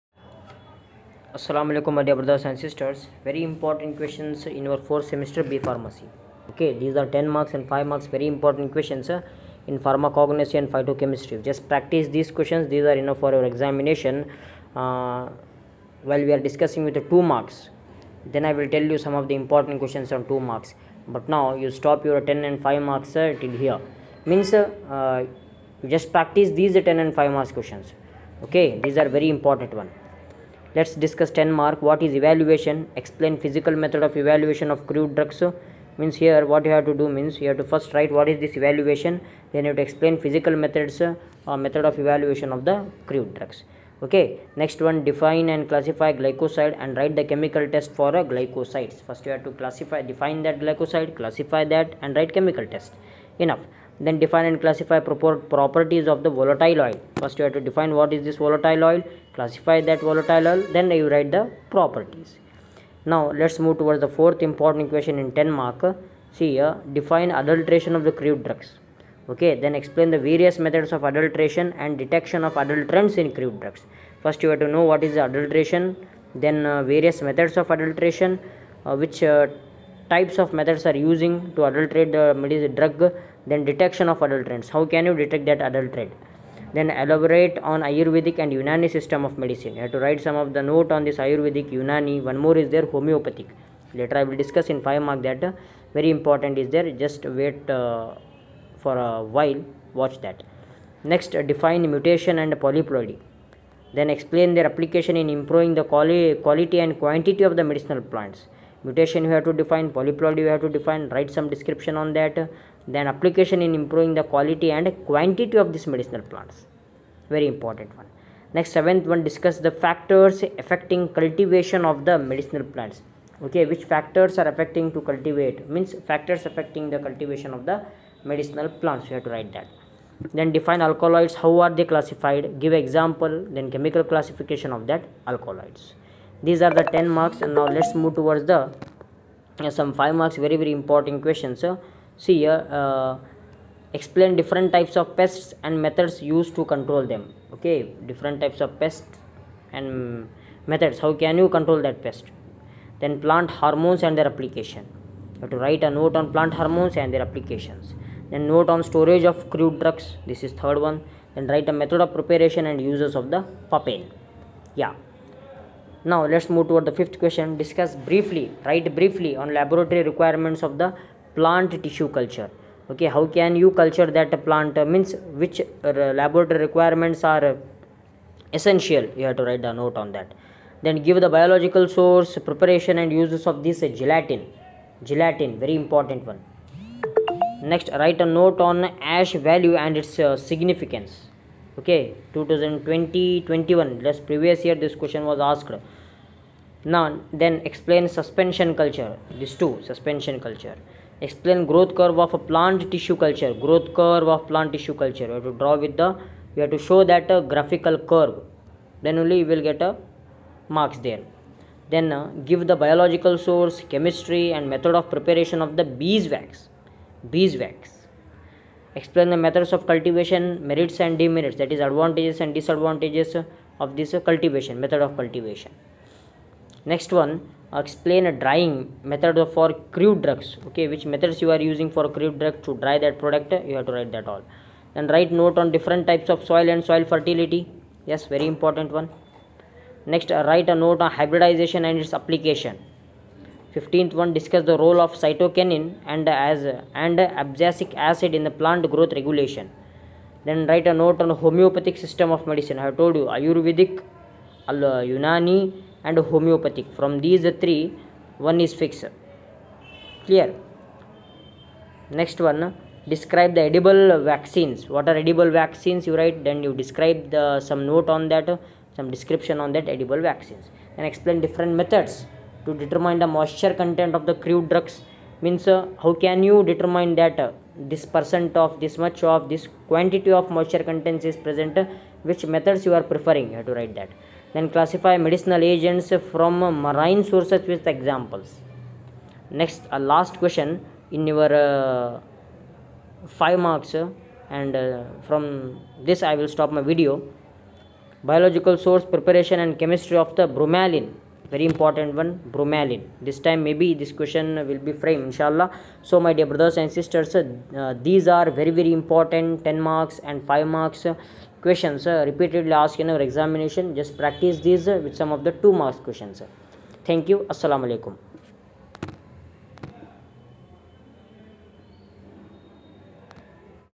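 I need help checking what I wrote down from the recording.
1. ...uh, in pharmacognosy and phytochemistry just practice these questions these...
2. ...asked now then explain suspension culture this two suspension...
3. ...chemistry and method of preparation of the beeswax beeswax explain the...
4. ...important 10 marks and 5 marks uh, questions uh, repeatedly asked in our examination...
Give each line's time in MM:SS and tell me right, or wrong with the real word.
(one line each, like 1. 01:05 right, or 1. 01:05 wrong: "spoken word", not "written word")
1. 00:09 right
2. 03:15 right
3. 03:33 right
4. 05:09 right.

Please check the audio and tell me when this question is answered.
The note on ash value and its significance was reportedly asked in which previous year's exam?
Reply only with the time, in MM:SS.
03:12.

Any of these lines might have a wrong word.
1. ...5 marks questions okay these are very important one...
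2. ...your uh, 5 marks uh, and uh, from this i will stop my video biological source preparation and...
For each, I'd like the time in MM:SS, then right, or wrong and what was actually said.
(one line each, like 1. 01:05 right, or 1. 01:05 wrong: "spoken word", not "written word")
1. 00:27 right
2. 04:51 right.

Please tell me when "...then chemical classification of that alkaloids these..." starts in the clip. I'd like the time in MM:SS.
02:13.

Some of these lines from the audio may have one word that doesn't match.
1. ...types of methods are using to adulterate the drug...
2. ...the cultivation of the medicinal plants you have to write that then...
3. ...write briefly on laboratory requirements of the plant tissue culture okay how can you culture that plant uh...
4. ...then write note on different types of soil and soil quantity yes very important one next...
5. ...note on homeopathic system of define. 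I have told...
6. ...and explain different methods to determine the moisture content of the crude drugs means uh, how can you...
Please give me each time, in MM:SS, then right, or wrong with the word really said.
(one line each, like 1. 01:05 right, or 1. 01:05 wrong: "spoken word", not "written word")
1. 01:20 right
2. 02:06 right
3. 02:48 right
4. 03:54 wrong: "fertility", not "quantity"
5. 04:10 wrong: "medicine", not "define"
6. 04:30 right.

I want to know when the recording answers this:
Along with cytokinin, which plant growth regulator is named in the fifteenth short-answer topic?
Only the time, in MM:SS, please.
04:07.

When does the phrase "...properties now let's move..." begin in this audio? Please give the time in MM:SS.
01:01.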